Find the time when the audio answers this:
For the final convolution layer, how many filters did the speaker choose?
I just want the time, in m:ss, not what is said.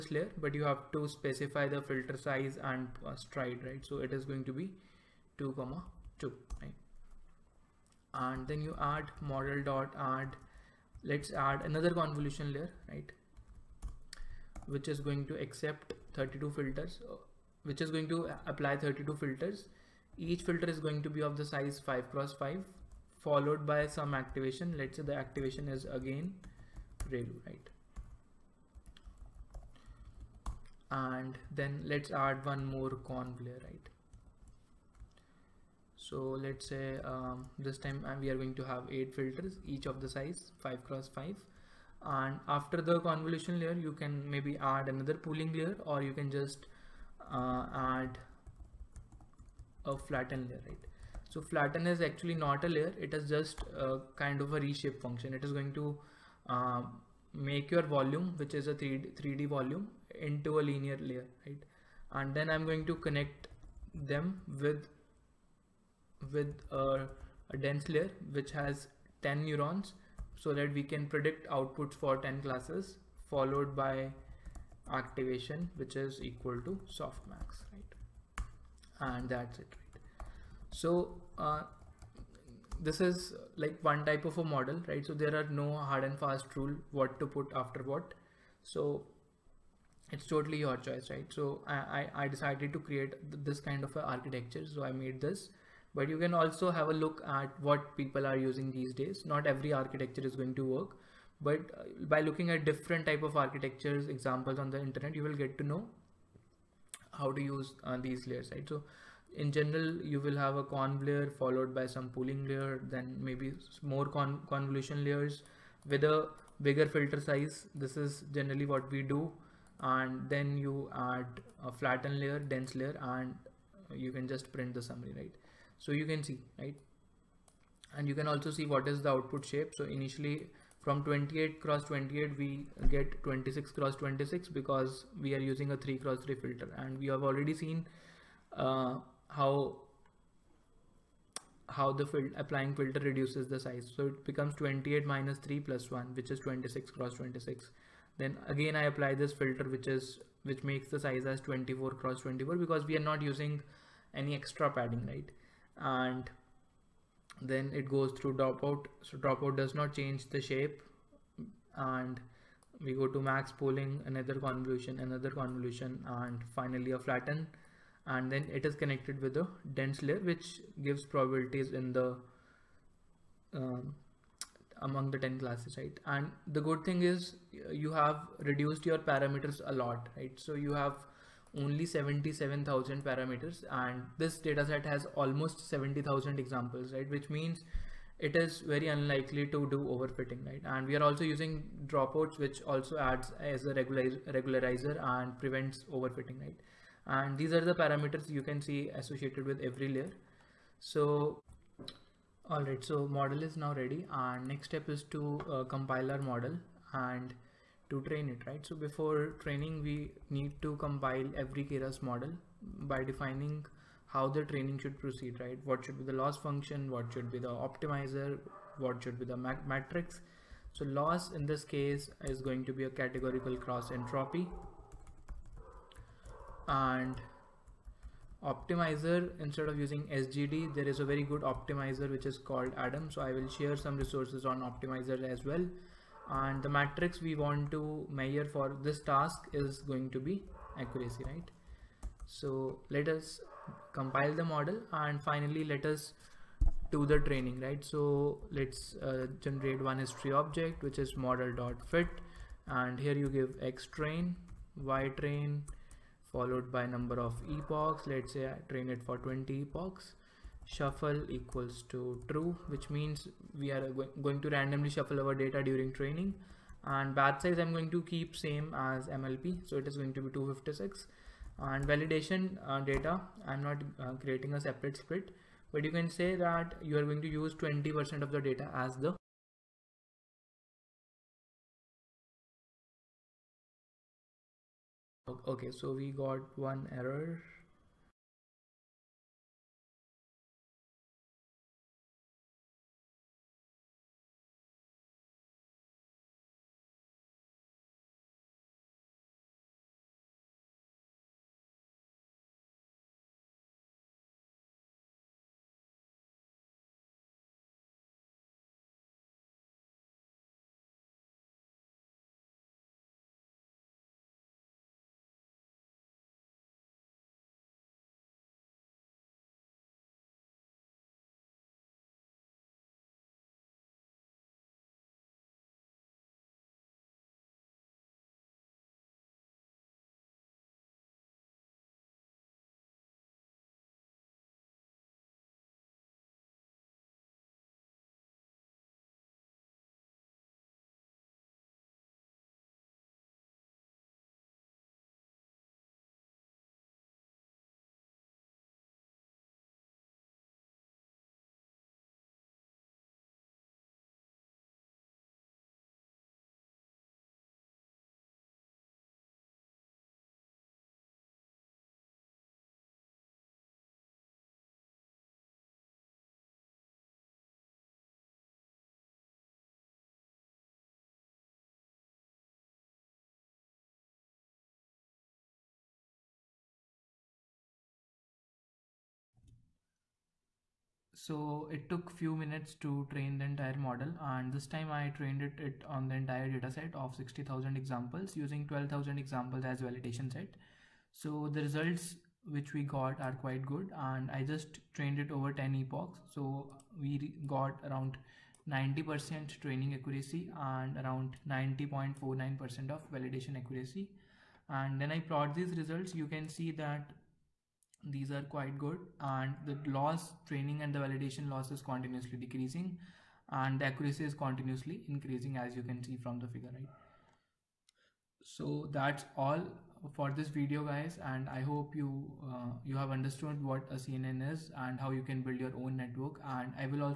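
0:38.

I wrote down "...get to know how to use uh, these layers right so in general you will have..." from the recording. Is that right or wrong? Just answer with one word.
right.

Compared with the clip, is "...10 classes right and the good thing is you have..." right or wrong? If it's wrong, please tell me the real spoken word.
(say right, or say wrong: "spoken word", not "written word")
right.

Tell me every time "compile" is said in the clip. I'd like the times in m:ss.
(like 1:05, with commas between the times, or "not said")
3:25, 3:30, 4:03.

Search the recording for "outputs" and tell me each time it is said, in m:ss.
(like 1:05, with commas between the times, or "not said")
1:11, 2:09.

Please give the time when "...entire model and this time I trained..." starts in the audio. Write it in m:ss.
6:23.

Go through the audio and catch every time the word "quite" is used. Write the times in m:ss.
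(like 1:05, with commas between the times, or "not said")
6:33, 6:48.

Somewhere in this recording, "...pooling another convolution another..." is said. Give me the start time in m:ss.
2:43.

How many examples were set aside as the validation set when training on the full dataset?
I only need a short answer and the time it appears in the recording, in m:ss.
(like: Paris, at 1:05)
12,000, at 6:28.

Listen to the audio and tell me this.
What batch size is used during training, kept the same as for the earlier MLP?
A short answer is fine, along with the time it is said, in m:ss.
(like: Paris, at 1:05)
256, at 4:30.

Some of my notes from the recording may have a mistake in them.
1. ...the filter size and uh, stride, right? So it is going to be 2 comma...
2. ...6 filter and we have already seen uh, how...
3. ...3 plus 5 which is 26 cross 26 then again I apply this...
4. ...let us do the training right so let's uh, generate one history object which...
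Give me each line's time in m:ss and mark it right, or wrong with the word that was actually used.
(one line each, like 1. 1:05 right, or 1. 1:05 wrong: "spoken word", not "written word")
1. 0:01 right
2. 2:16 wrong: "3", not "6"
3. 2:25 wrong: "1", not "5"
4. 4:05 right.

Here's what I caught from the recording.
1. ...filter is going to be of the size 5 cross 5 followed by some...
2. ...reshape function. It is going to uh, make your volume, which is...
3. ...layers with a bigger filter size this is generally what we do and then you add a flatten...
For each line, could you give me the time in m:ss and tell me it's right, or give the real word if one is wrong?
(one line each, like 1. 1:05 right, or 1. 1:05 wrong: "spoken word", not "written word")
1. 0:20 right
2. 0:54 right
3. 1:55 right.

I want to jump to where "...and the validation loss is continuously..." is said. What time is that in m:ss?
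6:50.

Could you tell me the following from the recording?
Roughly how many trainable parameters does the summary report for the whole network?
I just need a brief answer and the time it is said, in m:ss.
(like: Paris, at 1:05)
77,000, at 3:01.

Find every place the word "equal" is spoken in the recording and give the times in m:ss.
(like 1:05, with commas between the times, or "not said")
1:16, 4:21.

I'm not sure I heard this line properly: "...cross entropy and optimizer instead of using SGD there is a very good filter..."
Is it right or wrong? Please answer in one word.
wrong.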